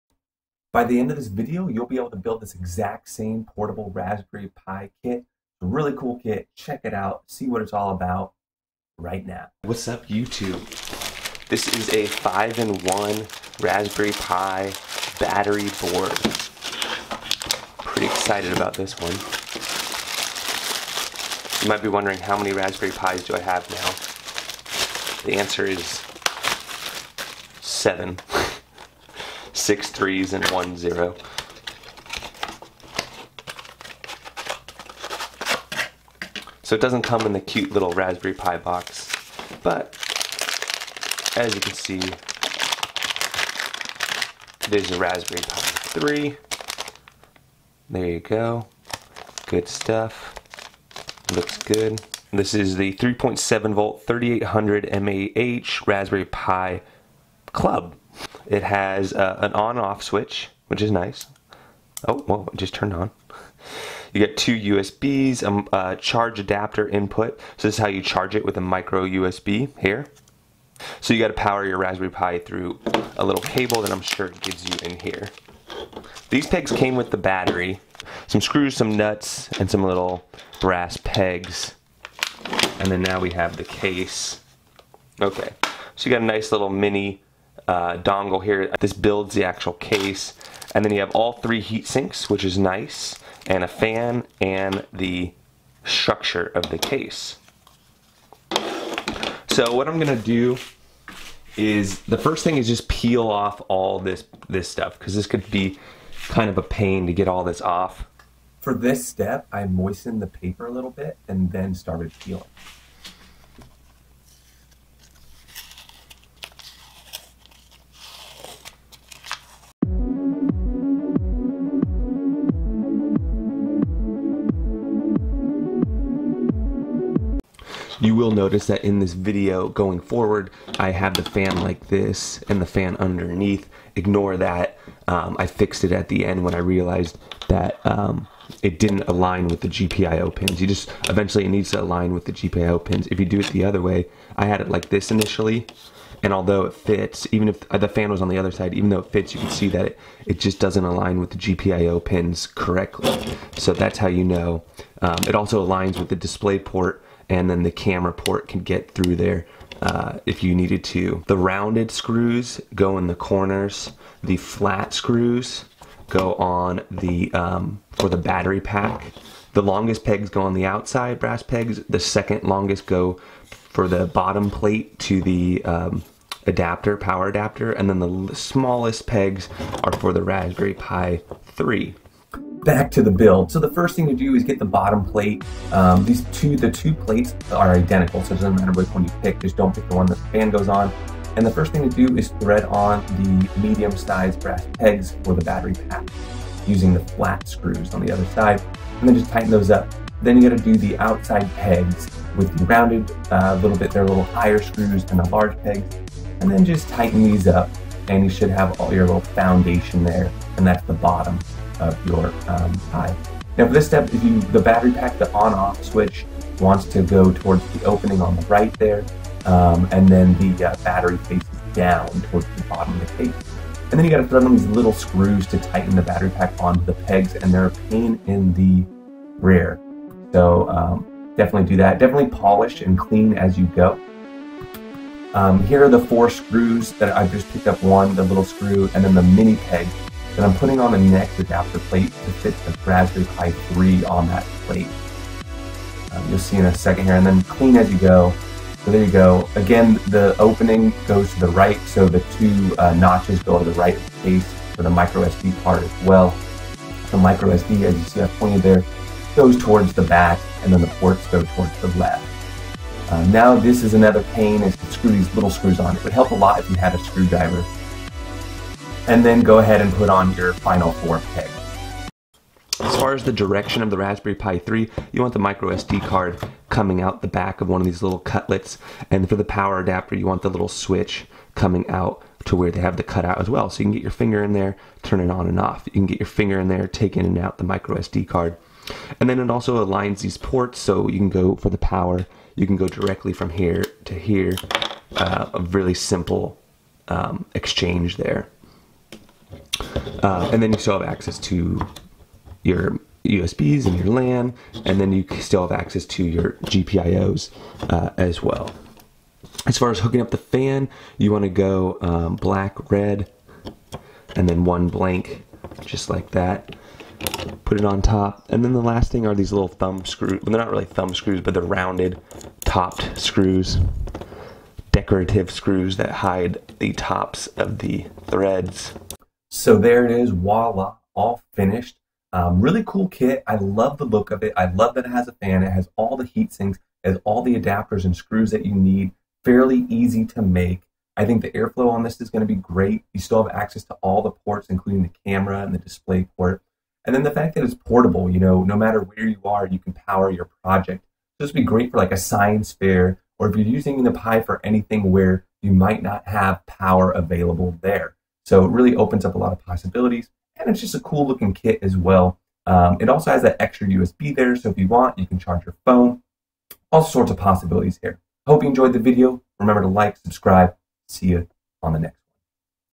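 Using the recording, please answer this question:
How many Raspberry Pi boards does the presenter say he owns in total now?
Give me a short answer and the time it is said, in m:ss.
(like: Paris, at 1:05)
7, at 0:27.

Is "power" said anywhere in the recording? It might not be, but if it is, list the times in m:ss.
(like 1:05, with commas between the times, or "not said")
1:11, 2:56, 4:39, 4:51, 5:49, 5:56.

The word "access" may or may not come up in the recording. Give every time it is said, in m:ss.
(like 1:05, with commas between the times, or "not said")
5:01, 5:05, 5:43.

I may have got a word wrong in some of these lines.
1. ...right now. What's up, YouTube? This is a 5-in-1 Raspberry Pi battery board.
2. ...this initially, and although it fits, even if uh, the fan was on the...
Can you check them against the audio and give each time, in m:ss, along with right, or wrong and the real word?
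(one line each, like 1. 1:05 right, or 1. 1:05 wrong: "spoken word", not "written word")
1. 0:08 right
2. 2:24 right.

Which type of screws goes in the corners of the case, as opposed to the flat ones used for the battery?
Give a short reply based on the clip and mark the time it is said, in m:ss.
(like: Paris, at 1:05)
rounded screws, at 2:41.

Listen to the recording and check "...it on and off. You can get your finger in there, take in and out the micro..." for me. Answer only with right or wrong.
right.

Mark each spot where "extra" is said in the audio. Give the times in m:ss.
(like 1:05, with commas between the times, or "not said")
6:03.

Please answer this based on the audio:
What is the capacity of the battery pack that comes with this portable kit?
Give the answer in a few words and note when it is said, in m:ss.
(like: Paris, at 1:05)
3800 mAh, at 0:54.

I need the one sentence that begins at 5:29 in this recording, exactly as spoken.
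So there it is, voila, all finished.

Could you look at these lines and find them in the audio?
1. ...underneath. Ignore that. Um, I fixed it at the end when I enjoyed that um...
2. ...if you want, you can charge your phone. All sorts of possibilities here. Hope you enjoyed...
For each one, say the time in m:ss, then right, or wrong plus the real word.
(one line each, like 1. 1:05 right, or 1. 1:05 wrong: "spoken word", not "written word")
1. 2:12 wrong: "realized", not "enjoyed"
2. 6:04 right.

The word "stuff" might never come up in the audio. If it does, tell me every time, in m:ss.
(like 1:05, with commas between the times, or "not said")
0:49, 1:44.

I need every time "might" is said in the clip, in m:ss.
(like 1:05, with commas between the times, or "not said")
0:21, 5:55.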